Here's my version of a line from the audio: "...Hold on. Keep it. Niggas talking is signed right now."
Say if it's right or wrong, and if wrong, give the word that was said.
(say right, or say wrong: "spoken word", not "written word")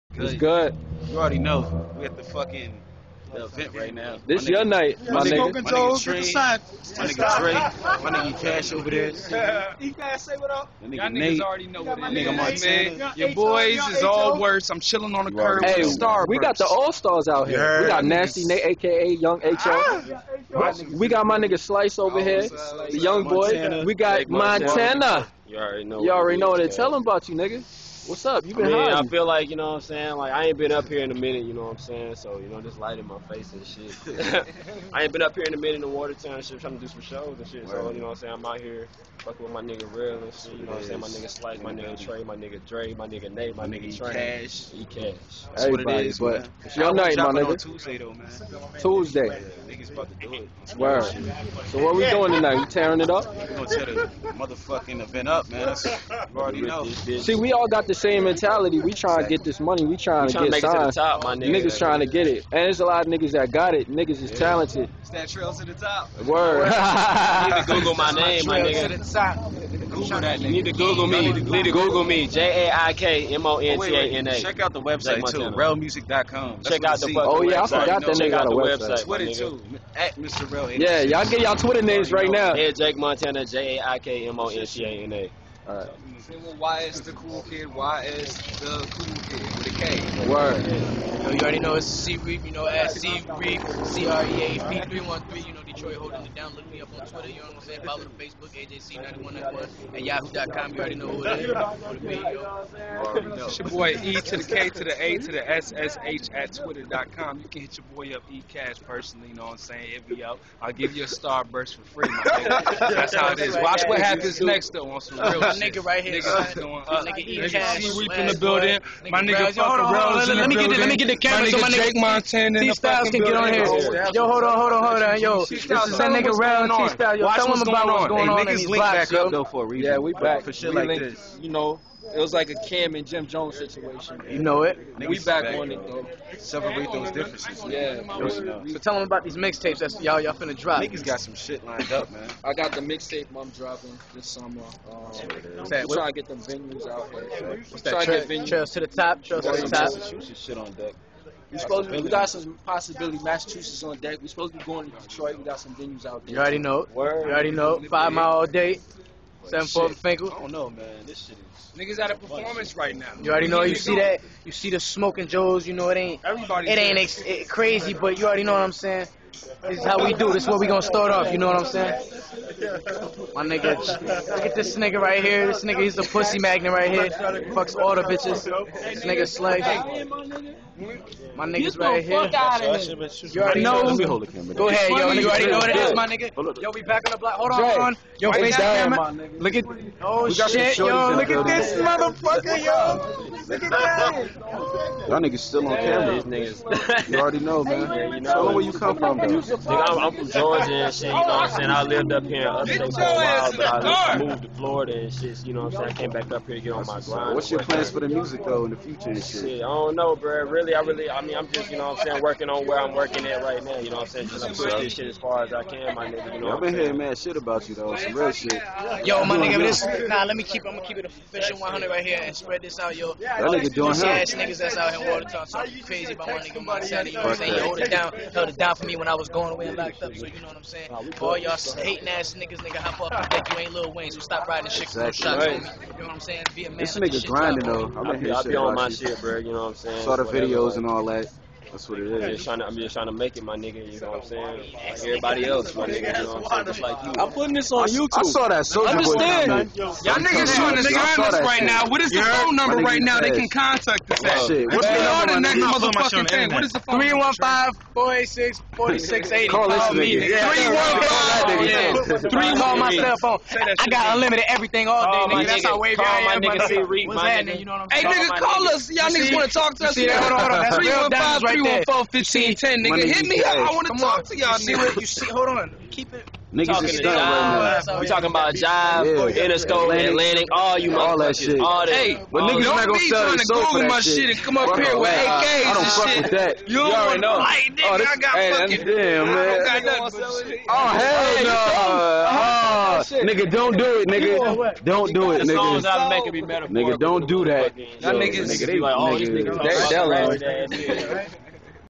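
wrong: "stunned", not "signed".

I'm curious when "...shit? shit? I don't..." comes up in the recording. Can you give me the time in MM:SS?
03:29.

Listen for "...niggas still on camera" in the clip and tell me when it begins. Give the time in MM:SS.
03:15.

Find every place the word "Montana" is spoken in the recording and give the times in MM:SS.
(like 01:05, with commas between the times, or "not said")
00:24, 01:22, 02:01.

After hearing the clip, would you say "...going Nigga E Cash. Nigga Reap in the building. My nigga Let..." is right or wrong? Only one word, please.
right.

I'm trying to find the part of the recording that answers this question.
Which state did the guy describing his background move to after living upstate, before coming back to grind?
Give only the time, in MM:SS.
03:24.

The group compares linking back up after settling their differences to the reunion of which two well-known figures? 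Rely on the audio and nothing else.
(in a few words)
Cam and Jim Jones.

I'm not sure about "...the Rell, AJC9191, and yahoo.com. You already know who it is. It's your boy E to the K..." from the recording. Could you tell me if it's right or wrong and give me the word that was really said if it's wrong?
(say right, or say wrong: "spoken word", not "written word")
wrong: "Facebook", not "Rell".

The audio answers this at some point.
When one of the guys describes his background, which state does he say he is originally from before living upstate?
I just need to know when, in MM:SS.
03:20.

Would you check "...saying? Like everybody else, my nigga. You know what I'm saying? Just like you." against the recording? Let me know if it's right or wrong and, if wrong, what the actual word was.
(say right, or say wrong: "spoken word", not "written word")
right.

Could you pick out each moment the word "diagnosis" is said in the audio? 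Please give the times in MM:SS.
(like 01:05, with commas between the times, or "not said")
not said.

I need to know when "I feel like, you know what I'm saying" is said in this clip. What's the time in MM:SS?
00:28.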